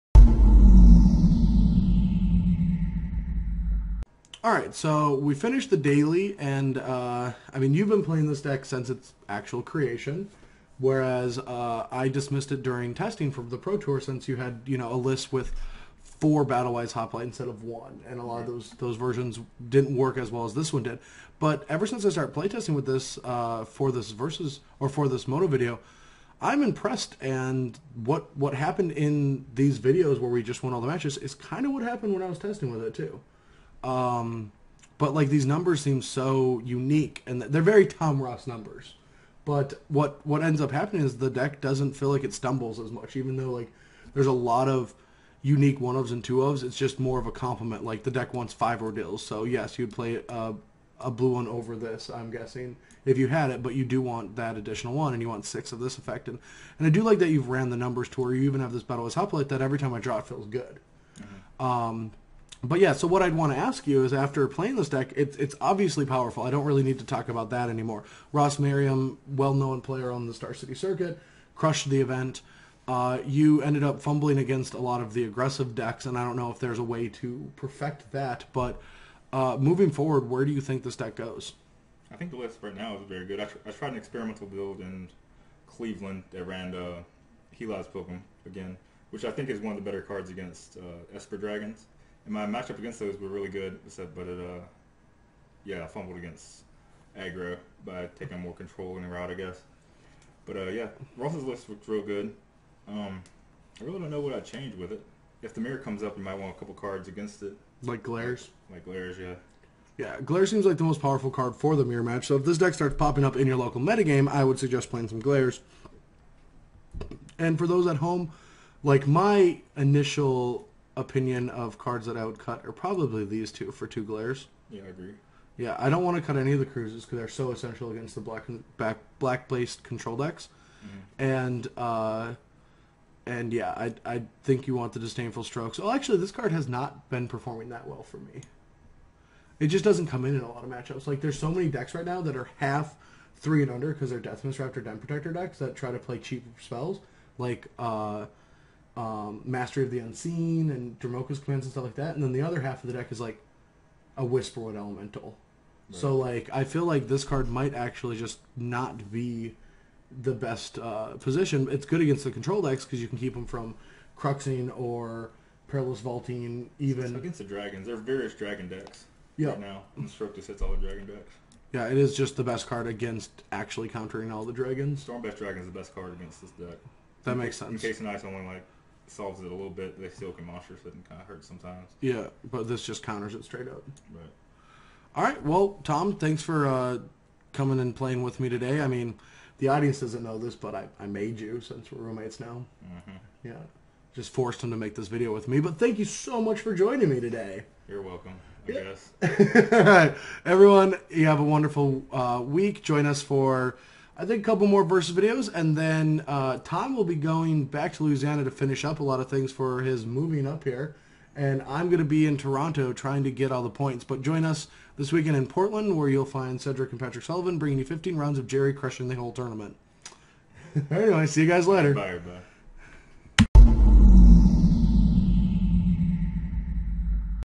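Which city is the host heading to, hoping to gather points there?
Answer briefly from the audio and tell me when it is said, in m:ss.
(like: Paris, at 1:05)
Toronto, at 3:32.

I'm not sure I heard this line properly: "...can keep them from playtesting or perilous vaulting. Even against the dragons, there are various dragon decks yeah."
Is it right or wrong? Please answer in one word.
wrong.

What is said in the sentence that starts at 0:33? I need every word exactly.
Um, but like these numbers seem so unique, and they're very Tom Ross numbers.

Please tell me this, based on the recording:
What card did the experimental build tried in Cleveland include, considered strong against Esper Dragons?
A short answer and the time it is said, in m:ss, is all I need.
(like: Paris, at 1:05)
Heliod's Pilgrim, at 1:27.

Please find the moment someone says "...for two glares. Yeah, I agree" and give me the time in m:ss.
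2:03.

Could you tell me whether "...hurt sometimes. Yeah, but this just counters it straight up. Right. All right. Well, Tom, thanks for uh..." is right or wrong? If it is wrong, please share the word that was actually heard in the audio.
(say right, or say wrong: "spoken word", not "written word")
right.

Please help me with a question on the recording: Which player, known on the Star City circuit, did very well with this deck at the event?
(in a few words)
Ross Merriam.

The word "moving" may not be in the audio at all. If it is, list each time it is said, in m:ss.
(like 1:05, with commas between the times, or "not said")
1:19, 3:30.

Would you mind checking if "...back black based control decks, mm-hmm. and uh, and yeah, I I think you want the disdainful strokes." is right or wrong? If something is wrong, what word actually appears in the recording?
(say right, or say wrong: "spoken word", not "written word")
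right.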